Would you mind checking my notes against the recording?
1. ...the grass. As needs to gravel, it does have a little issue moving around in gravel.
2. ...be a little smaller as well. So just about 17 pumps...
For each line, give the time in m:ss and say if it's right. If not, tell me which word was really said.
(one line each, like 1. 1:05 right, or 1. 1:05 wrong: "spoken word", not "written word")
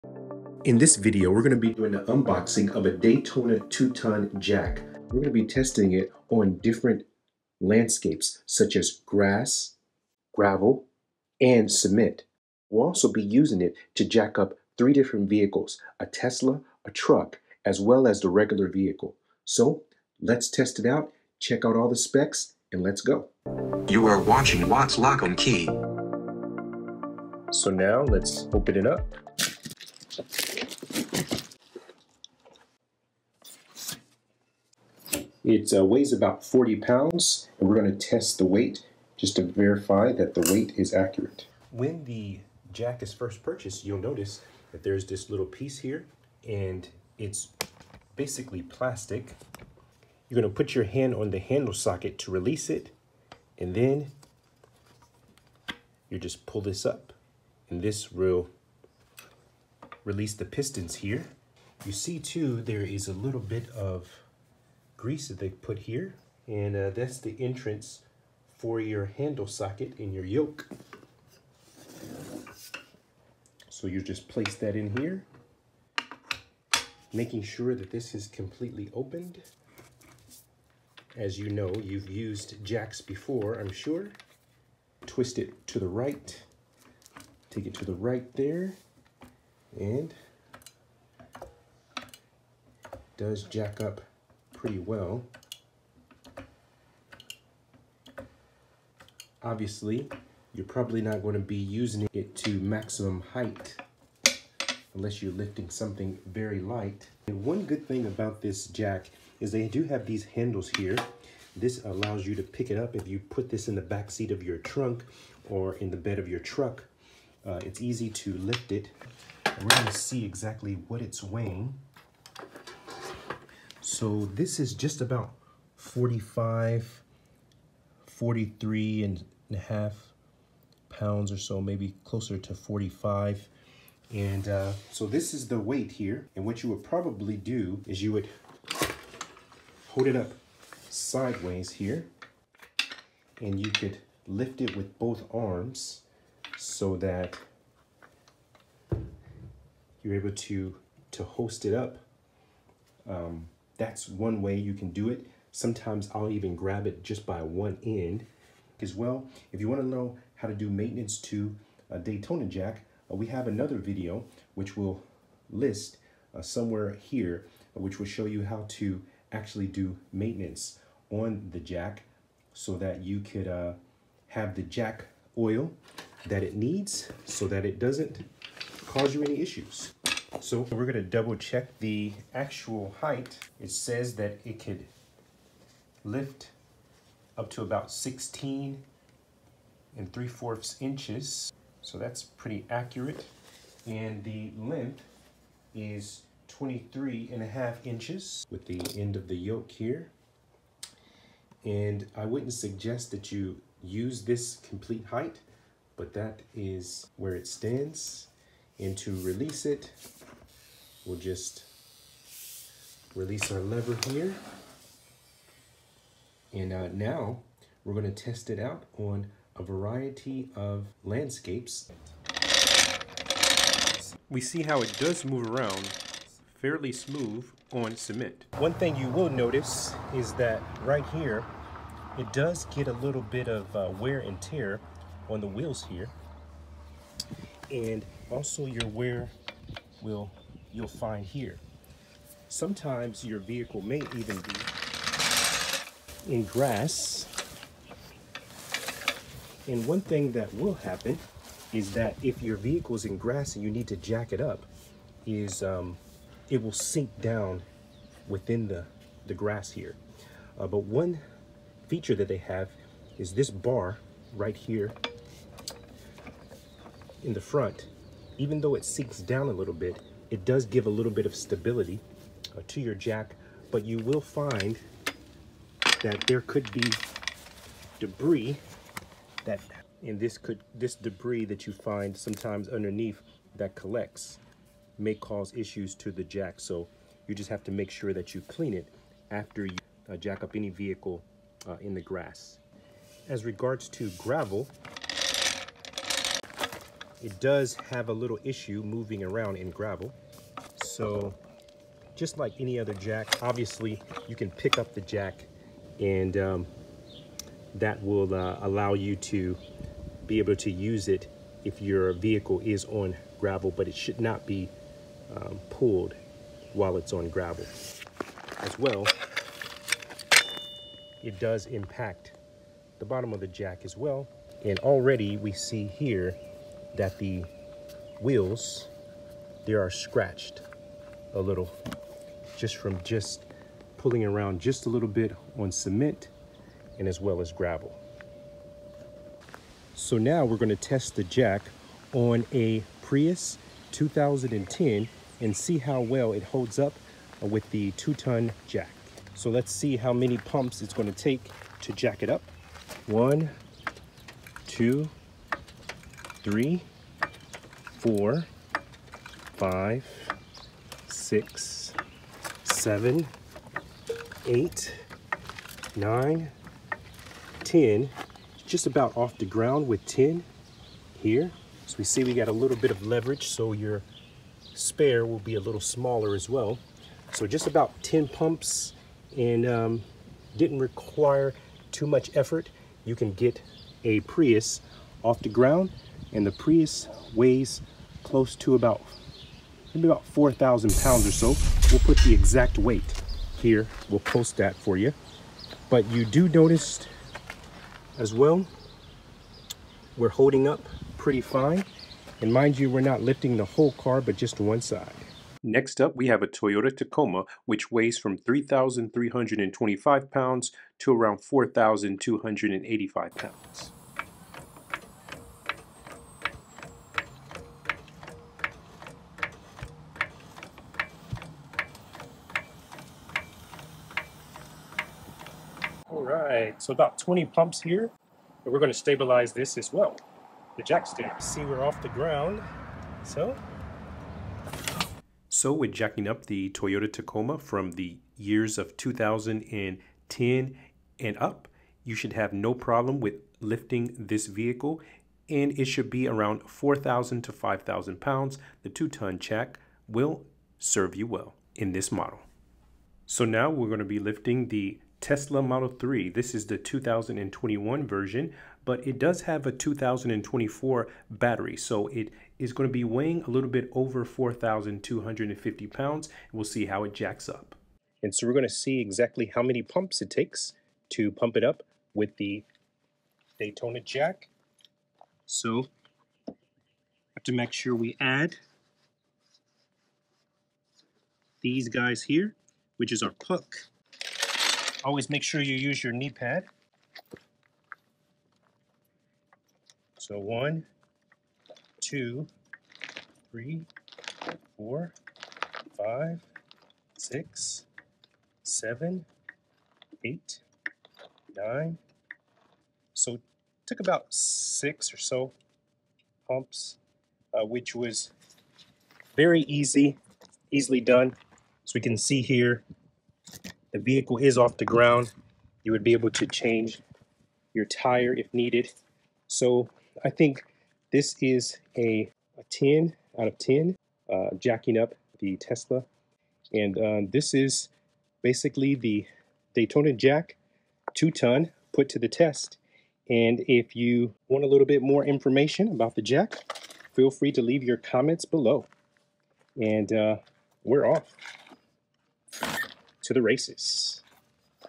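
1. 4:51 wrong: "regards", not "needs"
2. 6:15 wrong: "10", not "17".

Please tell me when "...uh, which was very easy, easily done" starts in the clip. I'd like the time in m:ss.
8:27.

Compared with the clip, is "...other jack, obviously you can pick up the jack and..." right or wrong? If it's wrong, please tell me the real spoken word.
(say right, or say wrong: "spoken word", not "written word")
right.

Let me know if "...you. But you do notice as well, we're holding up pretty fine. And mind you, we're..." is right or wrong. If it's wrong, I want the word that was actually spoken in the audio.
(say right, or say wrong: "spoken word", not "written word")
right.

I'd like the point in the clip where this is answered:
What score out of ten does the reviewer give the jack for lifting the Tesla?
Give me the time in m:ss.
8:42.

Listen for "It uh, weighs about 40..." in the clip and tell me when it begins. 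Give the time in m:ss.
0:35.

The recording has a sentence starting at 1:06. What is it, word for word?
And uh, that's the entrance for your handle socket in your yoke.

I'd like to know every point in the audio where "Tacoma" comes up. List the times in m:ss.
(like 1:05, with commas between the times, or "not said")
6:46, 7:17.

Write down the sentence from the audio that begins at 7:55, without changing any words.
So have to make sure we add these guys here, which is our puck Always make sure you use your knee pad.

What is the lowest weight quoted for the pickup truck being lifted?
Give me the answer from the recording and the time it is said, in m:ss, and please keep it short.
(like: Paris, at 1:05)
3,325 pounds, at 6:48.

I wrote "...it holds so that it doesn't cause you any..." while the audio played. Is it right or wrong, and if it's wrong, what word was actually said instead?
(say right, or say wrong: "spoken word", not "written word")
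wrong: "needs", not "holds".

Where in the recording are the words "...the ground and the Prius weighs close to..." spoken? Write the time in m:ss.
6:25.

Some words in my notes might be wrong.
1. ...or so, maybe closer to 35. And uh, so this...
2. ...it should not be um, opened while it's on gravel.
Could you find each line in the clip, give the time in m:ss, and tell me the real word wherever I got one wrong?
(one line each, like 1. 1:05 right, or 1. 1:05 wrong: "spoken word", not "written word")
1. 2:11 wrong: "45", not "35"
2. 5:13 wrong: "pulled", not "opened".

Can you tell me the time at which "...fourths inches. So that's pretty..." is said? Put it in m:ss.
3:10.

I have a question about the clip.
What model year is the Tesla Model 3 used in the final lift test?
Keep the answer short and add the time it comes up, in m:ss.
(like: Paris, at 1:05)
2021, at 7:36.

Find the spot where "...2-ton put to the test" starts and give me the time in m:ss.
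8:51.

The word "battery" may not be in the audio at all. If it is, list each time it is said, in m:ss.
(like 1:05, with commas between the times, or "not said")
7:41.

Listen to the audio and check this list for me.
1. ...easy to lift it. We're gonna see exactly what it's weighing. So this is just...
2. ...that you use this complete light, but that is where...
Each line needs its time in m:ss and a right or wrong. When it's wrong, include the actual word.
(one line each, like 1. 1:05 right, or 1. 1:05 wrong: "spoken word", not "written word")
1. 1:57 right
2. 3:23 wrong: "height", not "light".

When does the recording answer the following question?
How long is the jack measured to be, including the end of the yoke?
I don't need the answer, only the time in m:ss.
3:16.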